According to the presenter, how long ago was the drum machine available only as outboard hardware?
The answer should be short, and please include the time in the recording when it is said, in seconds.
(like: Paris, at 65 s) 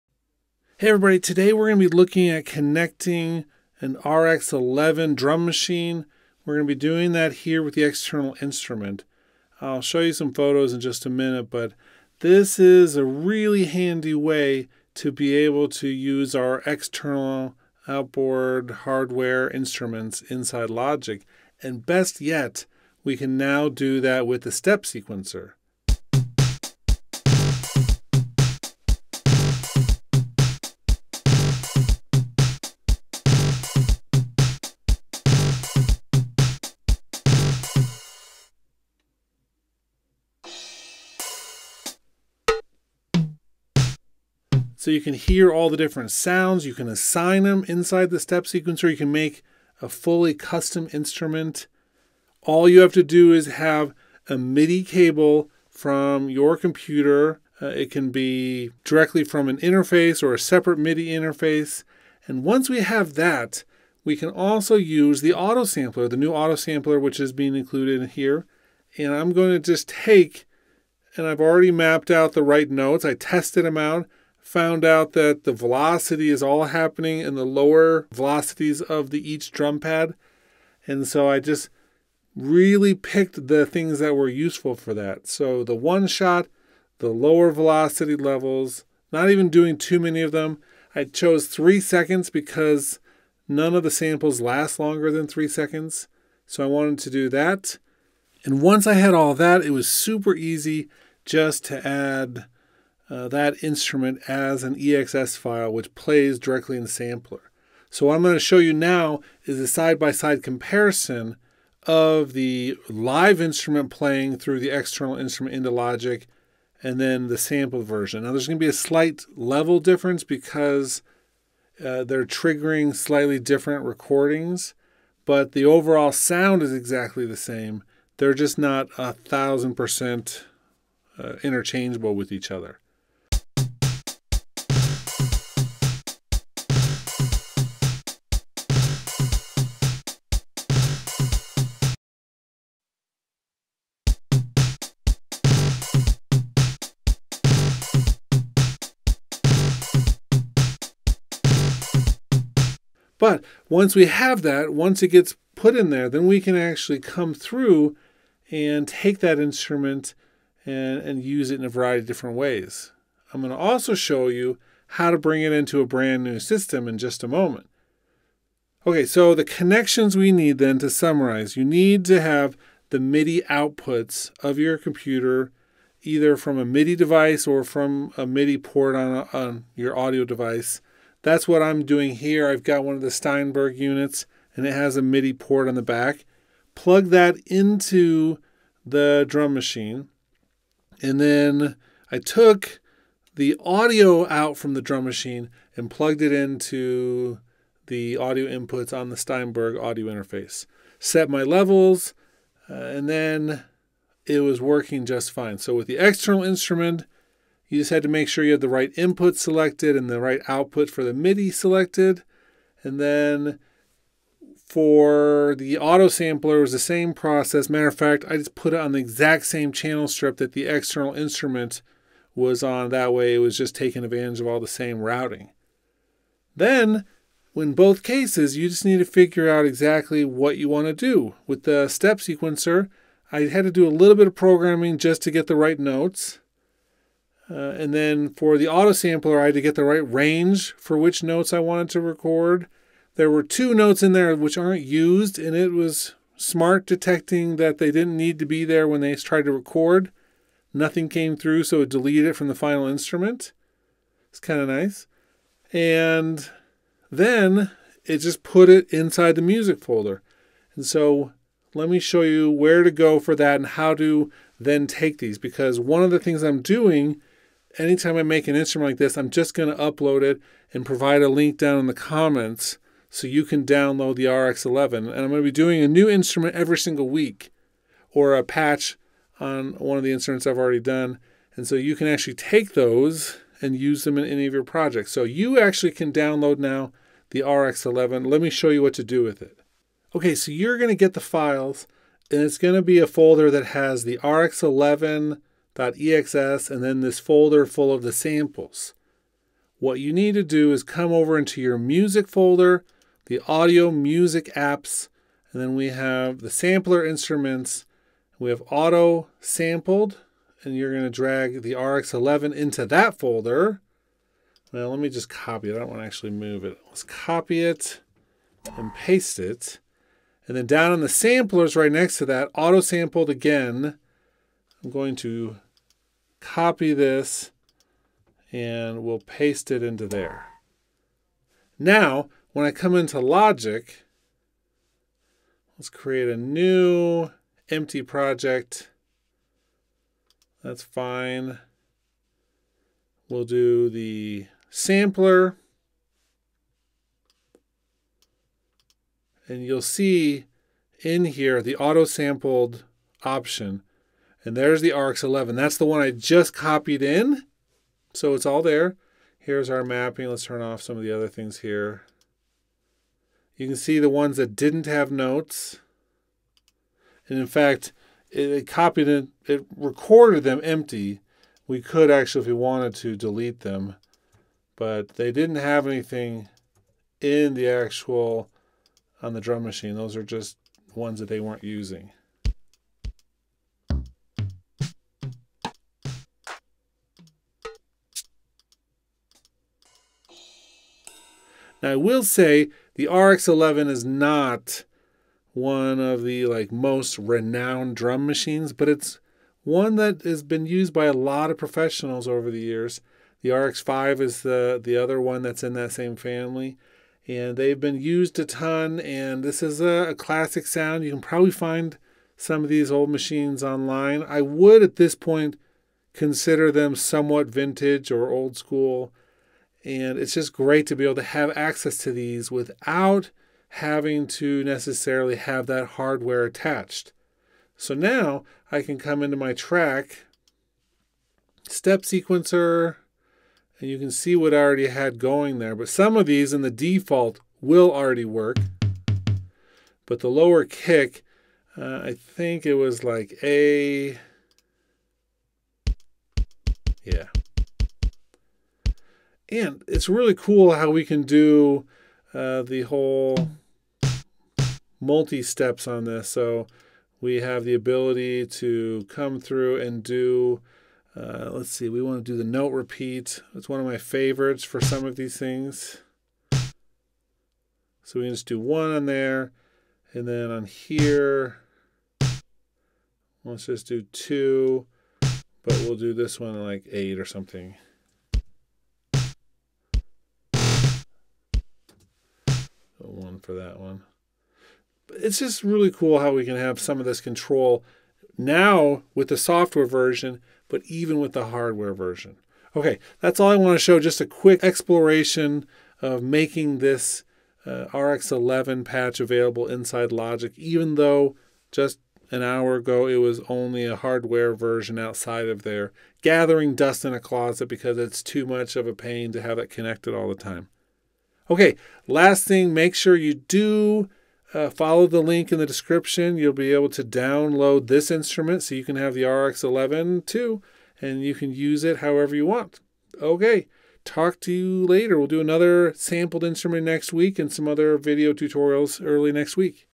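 An hour ago, at 502 s.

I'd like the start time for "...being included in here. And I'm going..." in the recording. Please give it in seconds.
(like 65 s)
67 s.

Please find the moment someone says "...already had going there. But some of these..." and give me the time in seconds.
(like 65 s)
434 s.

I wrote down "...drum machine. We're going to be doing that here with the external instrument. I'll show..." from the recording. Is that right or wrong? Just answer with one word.
right.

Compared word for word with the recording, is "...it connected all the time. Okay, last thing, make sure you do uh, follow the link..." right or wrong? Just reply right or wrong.
right.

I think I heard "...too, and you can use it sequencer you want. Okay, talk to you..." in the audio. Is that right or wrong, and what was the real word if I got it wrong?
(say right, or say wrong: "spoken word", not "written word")
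wrong: "however", not "sequencer".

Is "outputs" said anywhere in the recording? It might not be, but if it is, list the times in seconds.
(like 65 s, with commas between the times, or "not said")
173 s, 210 s.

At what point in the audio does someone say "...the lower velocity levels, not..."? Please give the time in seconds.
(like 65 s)
86 s.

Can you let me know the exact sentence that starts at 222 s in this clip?
That way it was just taking advantage of all the same routing.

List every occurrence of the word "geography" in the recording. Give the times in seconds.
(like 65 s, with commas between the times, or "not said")
not said.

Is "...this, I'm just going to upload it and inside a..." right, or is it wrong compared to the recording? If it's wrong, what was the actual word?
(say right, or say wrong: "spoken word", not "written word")
wrong: "provide", not "inside".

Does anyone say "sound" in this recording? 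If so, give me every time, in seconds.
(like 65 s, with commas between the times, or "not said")
46 s, 126 s, 410 s.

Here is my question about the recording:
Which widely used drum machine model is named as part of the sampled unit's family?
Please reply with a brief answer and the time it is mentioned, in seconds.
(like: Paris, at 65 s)
RX5, at 403 s.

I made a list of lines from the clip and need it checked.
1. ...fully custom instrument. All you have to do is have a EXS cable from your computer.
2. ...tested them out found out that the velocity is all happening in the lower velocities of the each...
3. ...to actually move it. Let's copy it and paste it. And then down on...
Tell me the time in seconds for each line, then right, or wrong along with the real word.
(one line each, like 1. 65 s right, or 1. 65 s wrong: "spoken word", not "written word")
1. 49 s wrong: "MIDI", not "EXS"
2. 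73 s right
3. 316 s right.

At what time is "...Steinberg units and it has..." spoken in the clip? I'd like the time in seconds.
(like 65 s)
183 s.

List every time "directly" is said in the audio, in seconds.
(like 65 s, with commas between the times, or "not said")
58 s, 106 s.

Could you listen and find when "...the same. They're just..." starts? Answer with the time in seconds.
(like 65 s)
127 s.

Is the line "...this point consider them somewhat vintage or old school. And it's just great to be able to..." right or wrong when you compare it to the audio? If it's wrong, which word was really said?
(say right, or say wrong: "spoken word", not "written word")
right.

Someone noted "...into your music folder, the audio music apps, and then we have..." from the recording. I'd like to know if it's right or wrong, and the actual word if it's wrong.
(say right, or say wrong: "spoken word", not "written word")
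right.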